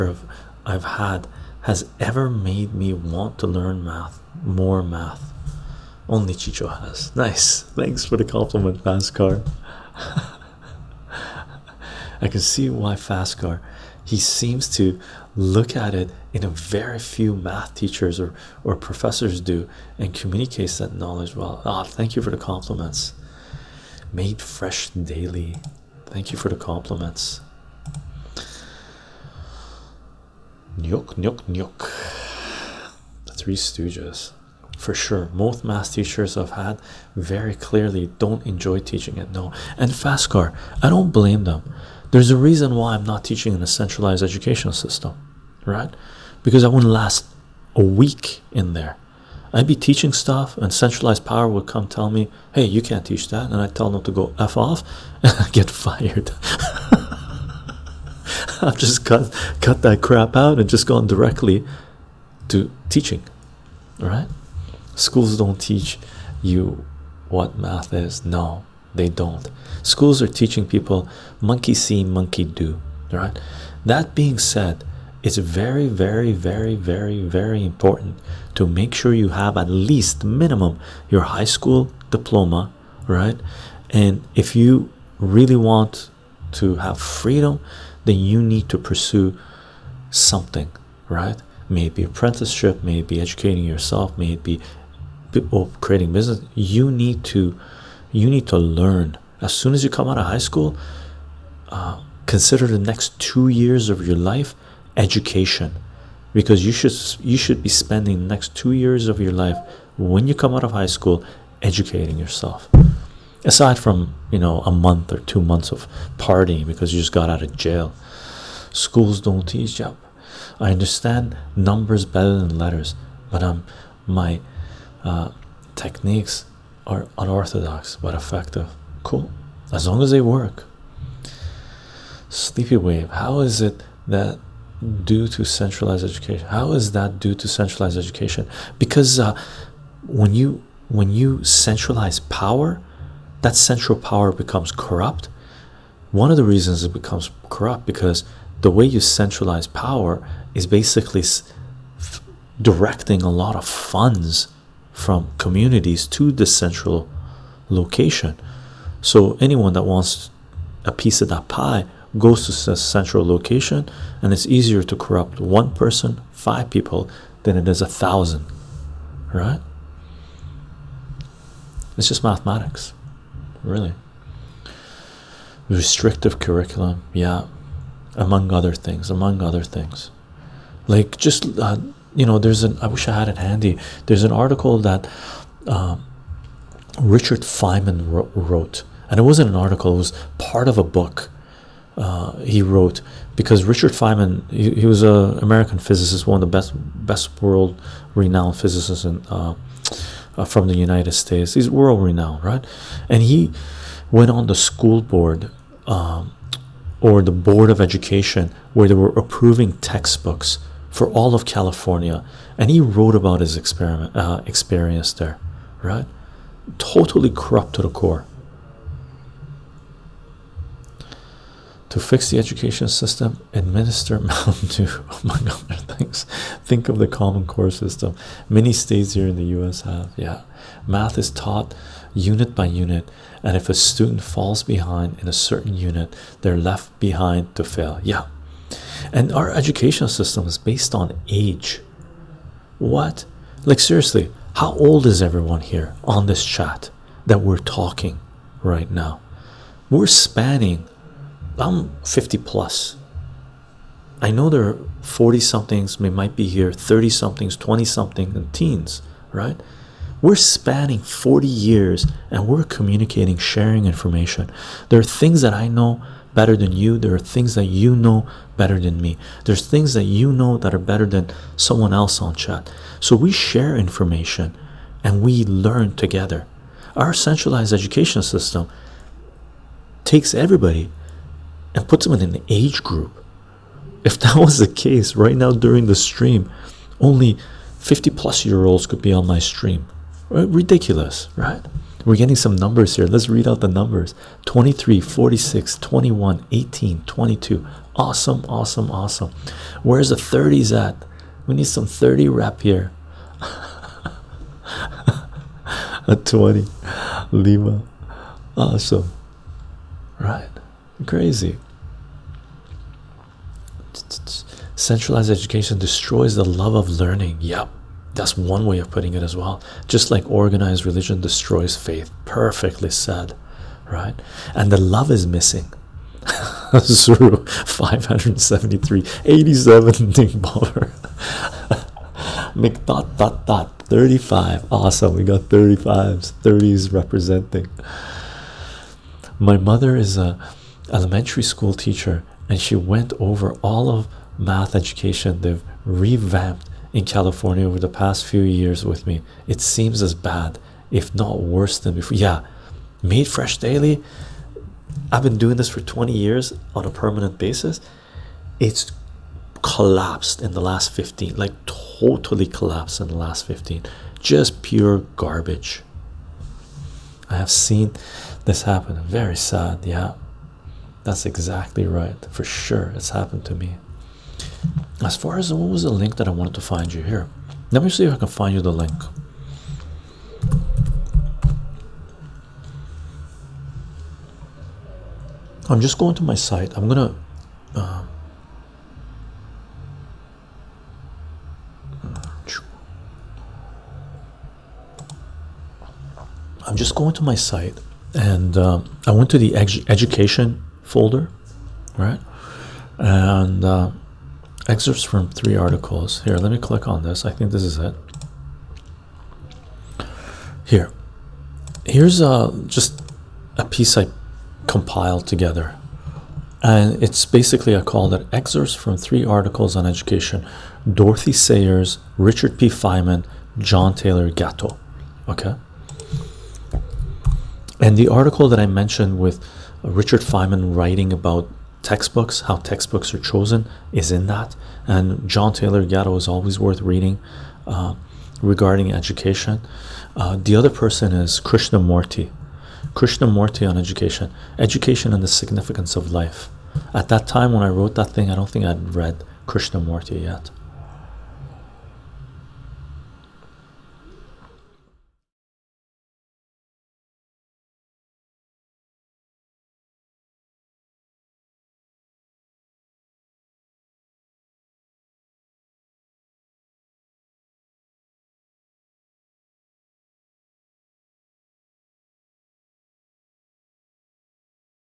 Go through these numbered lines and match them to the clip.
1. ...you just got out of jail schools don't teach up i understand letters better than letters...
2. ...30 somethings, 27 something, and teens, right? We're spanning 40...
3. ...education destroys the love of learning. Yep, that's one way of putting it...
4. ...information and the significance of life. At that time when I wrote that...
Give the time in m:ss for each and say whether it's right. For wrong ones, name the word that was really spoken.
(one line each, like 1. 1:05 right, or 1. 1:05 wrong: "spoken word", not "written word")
1. 1:56 wrong: "numbers", not "letters"
2. 4:16 wrong: "20", not "27"
3. 5:15 right
4. 7:24 wrong: "education", not "information".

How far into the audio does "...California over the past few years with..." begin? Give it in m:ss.
5:47.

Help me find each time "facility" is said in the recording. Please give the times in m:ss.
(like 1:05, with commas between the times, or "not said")
not said.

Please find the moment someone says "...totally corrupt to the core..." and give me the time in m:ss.
3:36.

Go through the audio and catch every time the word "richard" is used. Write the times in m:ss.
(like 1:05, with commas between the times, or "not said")
3:07, 3:13, 7:02, 7:09.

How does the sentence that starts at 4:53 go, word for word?
Let's read out the numbers 23, 46, 21, 18, 22.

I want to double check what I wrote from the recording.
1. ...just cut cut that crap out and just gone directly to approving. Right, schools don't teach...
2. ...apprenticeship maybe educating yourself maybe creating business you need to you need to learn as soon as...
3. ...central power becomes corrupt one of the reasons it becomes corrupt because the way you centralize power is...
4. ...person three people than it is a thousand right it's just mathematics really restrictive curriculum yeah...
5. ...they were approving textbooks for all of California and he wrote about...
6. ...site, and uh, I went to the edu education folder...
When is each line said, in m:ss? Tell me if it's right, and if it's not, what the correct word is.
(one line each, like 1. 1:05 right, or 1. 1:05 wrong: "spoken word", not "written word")
1. 0:58 wrong: "teaching", not "approving"
2. 1:32 right
3. 2:23 right
4. 2:45 wrong: "five", not "three"
5. 3:28 right
6. 6:37 right.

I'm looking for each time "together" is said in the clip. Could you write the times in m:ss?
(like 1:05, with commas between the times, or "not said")
4:35, 6:55.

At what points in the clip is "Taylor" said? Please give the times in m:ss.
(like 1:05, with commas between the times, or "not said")
7:03, 7:15.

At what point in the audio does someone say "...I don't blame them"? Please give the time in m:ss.
0:40.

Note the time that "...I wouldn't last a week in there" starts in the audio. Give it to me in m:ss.
0:46.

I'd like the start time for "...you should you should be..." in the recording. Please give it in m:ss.
1:46.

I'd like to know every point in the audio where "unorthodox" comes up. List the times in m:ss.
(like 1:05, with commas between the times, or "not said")
2:07.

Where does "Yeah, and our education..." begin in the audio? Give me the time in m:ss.
3:58.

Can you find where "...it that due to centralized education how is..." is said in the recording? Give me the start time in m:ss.
2:13.